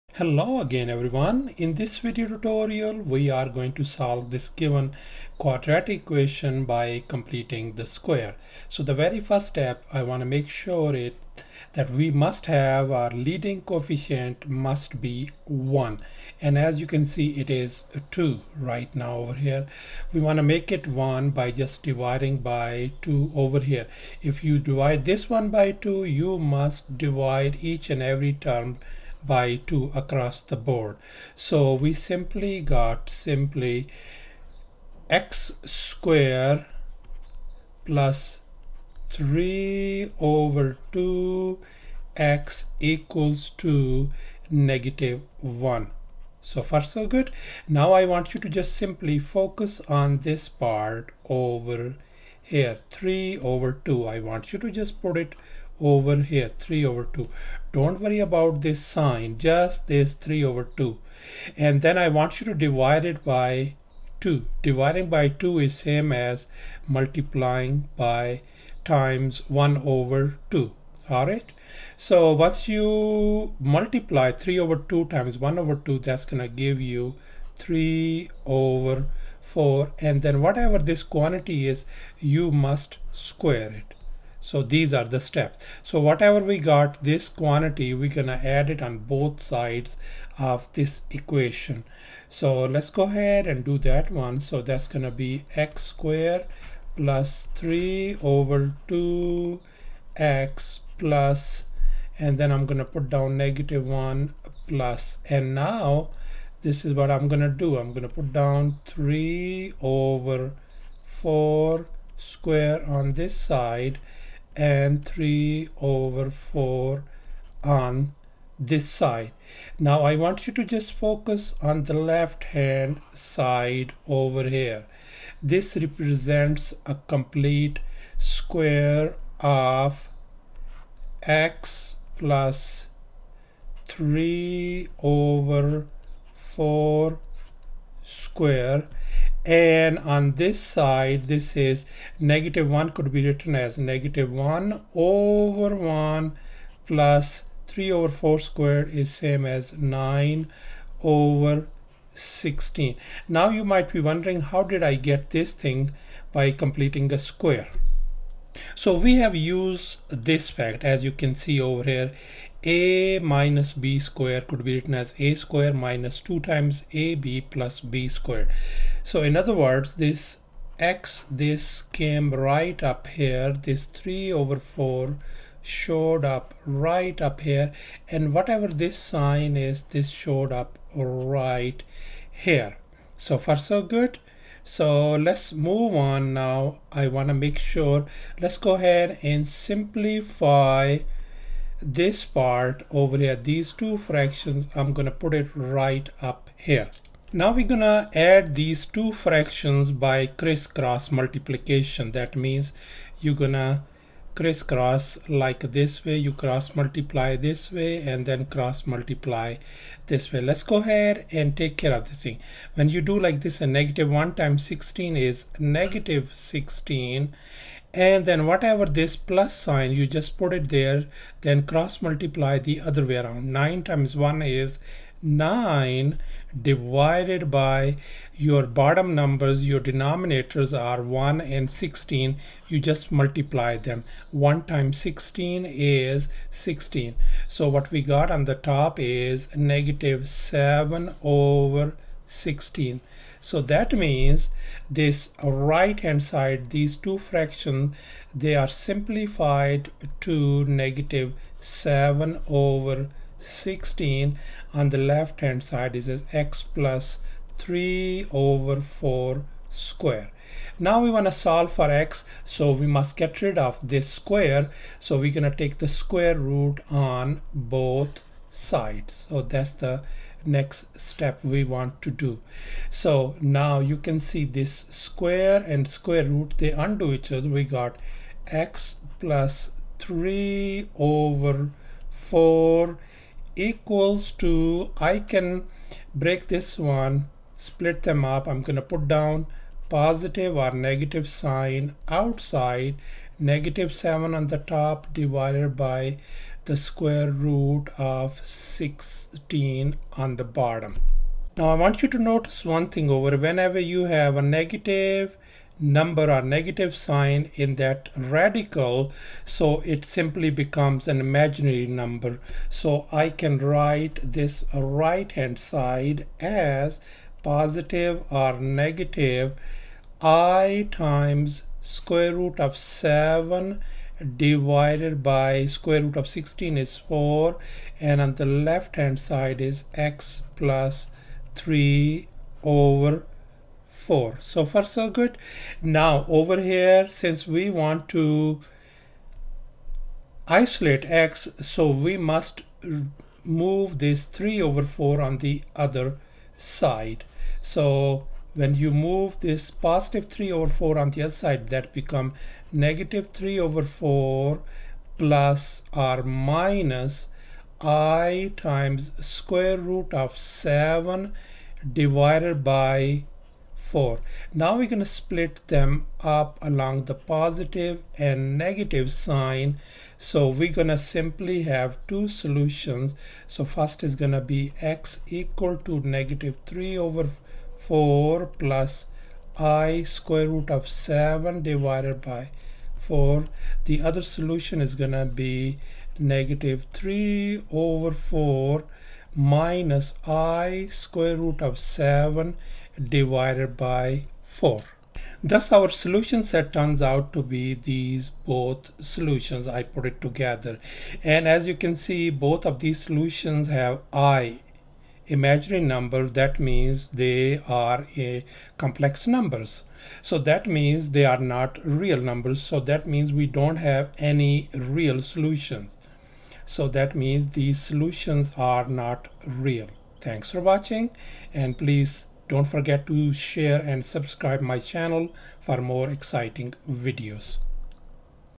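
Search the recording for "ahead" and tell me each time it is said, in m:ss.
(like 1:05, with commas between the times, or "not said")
1:33, 3:08, 3:30.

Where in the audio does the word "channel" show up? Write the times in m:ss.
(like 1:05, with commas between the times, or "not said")
7:04.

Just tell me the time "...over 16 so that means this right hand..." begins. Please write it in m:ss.
4:01.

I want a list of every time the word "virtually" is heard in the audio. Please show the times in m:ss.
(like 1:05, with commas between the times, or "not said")
not said.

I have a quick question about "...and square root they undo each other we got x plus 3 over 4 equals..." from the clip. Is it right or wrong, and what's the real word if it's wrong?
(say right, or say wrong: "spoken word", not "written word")
right.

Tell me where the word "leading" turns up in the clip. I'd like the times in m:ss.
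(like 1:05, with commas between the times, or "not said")
0:13.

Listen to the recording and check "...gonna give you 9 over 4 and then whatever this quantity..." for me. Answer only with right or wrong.
wrong.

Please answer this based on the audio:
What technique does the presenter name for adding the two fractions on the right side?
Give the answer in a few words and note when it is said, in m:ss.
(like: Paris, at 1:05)
crisscross multiplication, at 3:20.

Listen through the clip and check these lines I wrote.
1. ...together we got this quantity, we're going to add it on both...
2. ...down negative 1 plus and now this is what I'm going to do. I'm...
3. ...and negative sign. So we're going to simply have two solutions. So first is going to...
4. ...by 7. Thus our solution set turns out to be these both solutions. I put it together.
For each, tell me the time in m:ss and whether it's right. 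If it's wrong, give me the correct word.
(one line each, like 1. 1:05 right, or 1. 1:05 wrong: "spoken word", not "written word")
1. 1:25 wrong: "whatever", not "together"
2. 1:43 right
3. 6:08 right
4. 6:33 wrong: "4", not "7".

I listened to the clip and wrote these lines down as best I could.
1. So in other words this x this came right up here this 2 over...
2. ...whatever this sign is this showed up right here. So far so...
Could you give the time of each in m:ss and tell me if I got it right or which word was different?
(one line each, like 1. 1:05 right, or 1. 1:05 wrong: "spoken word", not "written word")
1. 2:49 wrong: "3", not "2"
2. 2:58 right.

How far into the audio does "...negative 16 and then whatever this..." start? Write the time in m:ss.
3:35.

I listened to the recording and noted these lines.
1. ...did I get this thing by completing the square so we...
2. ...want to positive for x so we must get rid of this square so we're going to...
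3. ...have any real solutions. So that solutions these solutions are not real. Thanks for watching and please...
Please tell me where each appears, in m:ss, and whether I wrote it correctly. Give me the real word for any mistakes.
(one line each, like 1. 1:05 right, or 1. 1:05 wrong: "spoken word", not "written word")
1. 2:34 right
2. 4:21 wrong: "solve", not "positive"
3. 6:53 wrong: "means", not "solutions".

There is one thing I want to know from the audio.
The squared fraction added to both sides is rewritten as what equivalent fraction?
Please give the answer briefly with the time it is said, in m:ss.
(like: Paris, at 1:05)
9/16, at 2:29.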